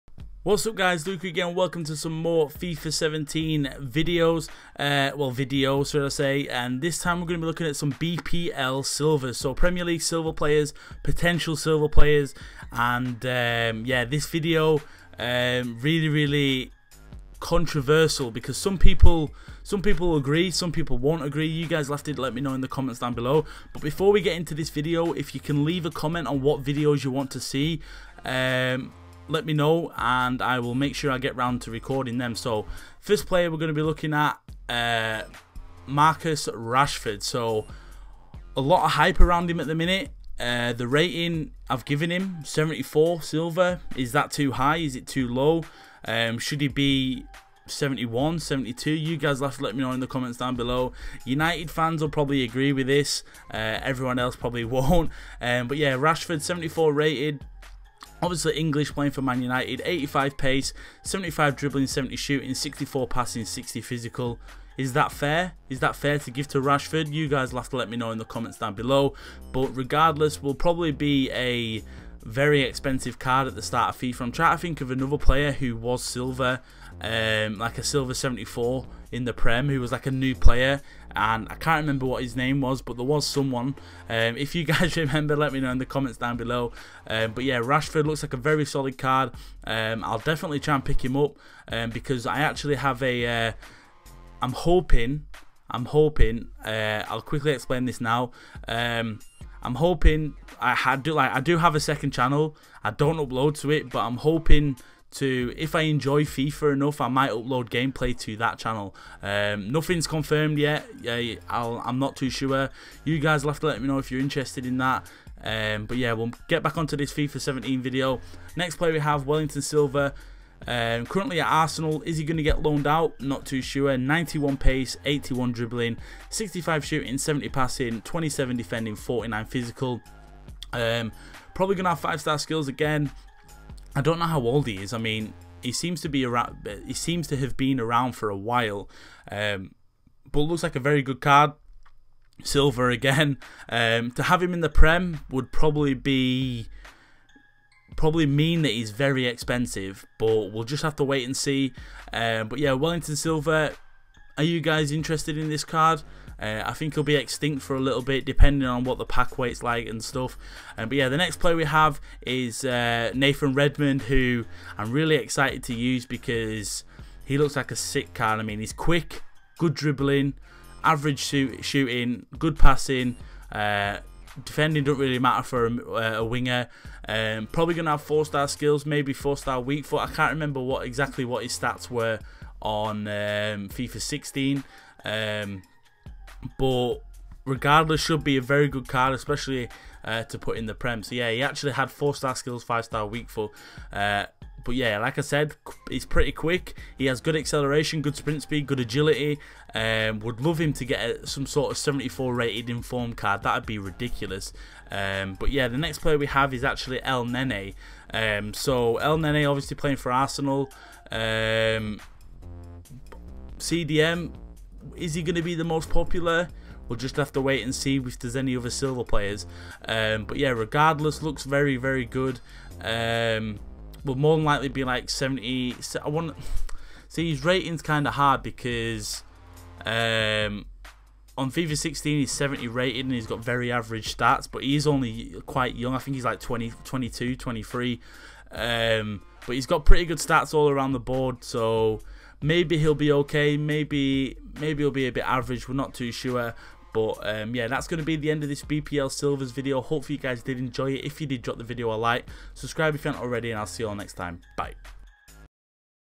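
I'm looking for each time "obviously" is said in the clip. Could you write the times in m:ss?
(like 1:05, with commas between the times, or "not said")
0:58, 3:29.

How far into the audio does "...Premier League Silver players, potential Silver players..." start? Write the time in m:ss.
0:09.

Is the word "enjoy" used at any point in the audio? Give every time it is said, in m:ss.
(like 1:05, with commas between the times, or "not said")
1:45, 4:10.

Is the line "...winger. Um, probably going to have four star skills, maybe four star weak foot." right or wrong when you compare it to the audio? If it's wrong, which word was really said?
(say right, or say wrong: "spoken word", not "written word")
right.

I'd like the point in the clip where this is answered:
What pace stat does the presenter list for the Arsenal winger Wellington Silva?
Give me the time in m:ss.
2:03.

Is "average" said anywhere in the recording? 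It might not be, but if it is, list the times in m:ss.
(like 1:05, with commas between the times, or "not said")
2:50, 3:53, 4:05.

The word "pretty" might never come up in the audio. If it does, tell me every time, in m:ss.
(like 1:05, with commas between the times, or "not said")
3:16, 3:59.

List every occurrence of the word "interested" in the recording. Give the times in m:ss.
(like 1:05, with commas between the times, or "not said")
1:54, 2:34.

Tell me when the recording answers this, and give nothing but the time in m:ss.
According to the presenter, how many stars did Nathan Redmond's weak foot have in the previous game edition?
3:12.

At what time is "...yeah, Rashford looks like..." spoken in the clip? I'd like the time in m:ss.
1:27.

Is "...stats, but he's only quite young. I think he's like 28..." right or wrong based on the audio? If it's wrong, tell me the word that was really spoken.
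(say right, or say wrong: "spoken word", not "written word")
wrong: "20", not "28".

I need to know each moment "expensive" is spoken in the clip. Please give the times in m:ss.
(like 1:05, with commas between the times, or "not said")
1:12, 2:29.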